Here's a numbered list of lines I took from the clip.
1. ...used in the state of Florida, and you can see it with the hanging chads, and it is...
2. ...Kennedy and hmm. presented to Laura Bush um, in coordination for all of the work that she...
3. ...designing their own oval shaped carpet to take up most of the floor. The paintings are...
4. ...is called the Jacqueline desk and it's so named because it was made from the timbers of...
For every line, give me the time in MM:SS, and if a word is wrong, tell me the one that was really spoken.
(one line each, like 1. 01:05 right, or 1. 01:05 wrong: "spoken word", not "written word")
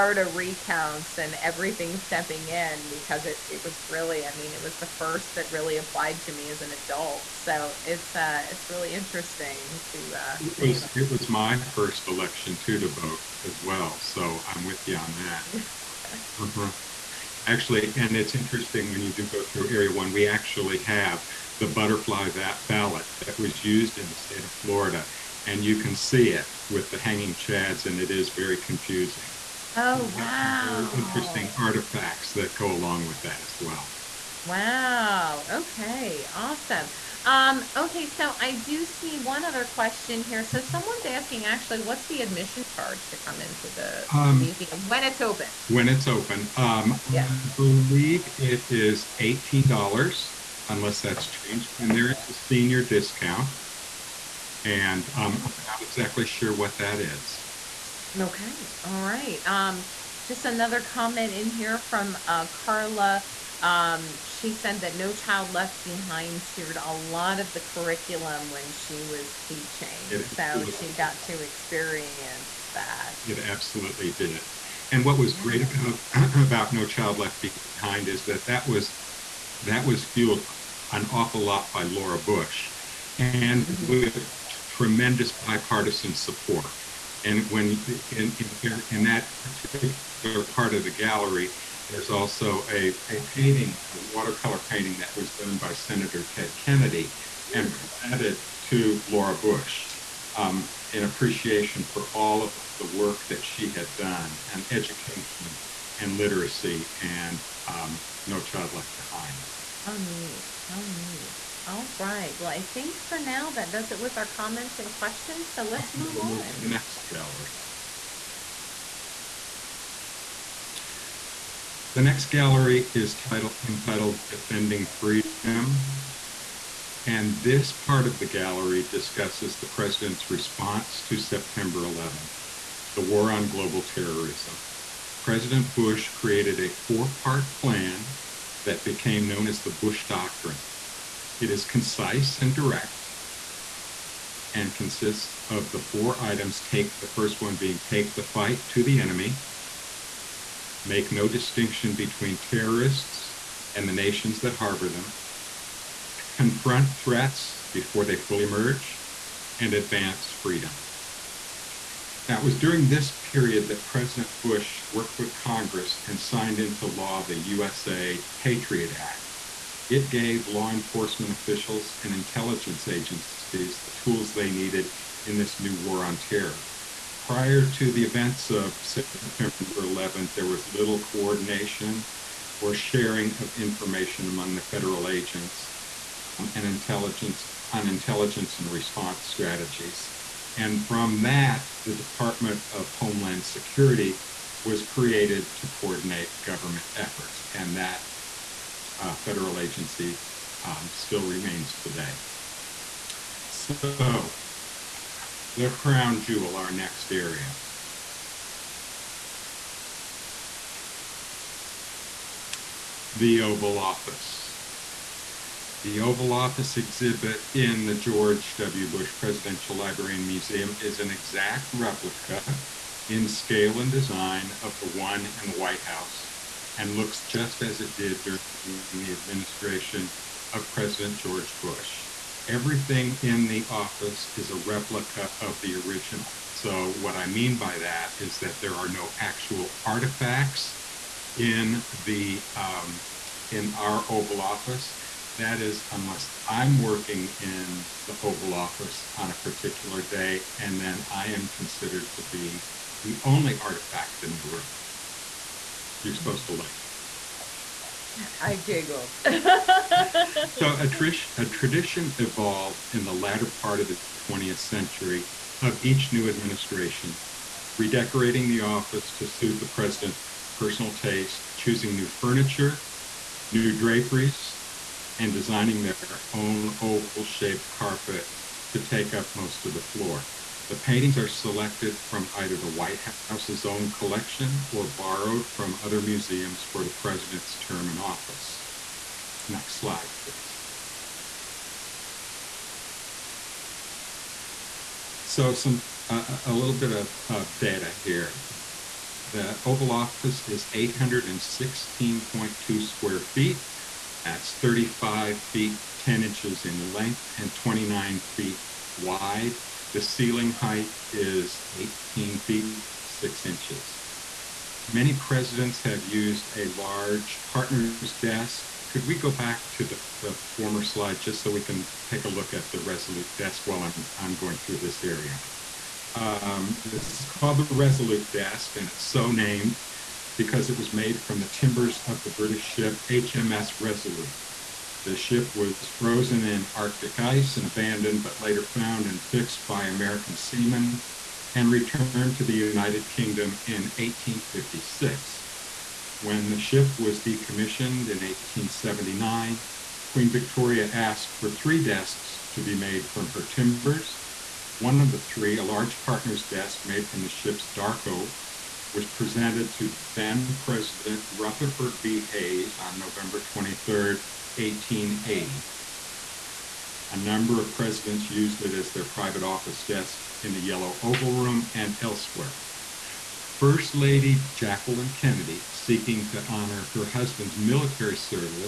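1. 00:23 right
2. 01:36 wrong: "appreciation", not "coordination"
3. 04:35 right
4. 05:27 wrong: "Resolute", not "Jacqueline".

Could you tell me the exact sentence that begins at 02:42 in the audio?
Now, it was during this period that President Bush worked with Congress and signed into law the USA Patriot Act.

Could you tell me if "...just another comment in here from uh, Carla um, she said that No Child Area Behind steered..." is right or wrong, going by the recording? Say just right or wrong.
wrong.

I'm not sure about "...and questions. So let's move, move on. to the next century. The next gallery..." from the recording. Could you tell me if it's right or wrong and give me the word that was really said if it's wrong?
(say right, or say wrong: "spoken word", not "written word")
wrong: "gallery", not "century".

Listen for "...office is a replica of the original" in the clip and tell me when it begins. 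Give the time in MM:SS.
03:53.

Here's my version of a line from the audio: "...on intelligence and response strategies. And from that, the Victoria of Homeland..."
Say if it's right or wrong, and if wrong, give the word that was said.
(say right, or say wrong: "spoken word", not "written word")
wrong: "Department", not "Victoria".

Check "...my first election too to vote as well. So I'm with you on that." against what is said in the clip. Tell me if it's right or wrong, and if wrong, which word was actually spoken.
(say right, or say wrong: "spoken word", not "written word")
right.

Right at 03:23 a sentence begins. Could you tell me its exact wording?
So, the crown jewel, our next area.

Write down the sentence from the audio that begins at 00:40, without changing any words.
So someone's asking actually, what's the admission charge to come into the um, museum when it's open?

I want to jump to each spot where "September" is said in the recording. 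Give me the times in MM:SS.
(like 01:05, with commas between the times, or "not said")
02:11, 02:58.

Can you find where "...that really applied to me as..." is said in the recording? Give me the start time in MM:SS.
00:05.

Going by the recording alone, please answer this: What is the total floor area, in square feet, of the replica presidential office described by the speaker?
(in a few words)
816.2.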